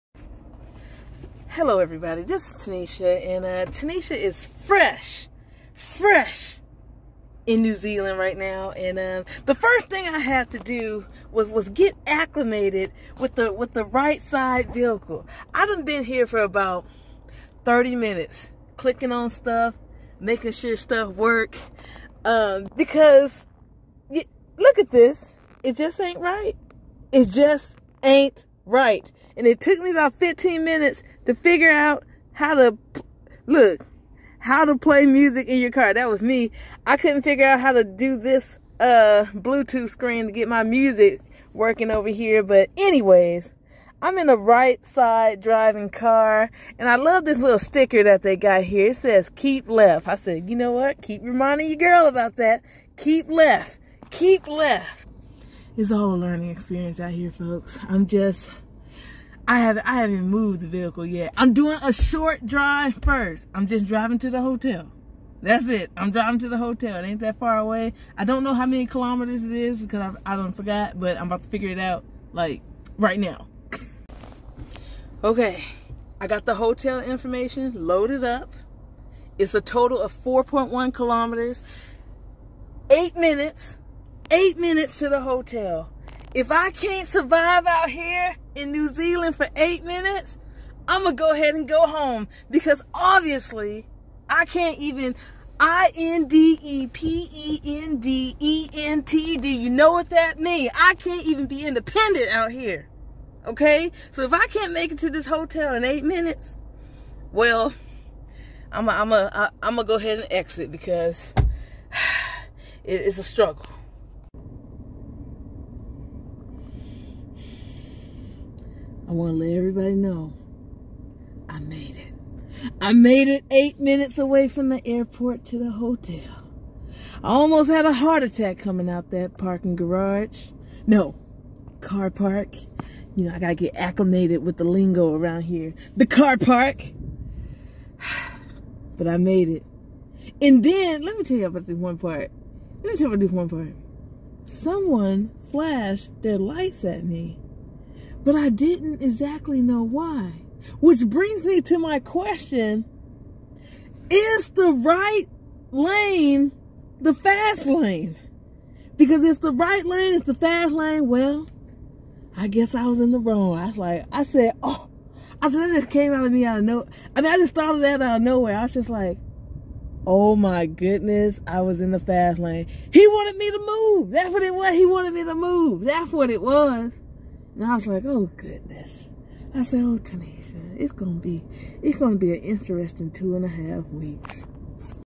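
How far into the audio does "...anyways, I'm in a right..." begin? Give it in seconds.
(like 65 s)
42 s.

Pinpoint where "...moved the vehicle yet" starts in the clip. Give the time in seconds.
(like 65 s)
60 s.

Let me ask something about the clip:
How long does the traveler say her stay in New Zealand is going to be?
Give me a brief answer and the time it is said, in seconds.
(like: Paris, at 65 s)
Two and a half weeks, at 183 s.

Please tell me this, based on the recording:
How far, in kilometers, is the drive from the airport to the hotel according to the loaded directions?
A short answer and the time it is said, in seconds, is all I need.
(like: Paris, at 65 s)
4.1 kilometers, at 80 s.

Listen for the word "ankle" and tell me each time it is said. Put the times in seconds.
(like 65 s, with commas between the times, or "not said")
not said.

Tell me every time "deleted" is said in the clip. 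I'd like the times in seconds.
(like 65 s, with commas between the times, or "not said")
not said.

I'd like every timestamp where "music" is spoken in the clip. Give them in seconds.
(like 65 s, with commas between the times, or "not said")
35 s, 40 s.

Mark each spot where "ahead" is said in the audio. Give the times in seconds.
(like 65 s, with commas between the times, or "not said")
91 s, 109 s.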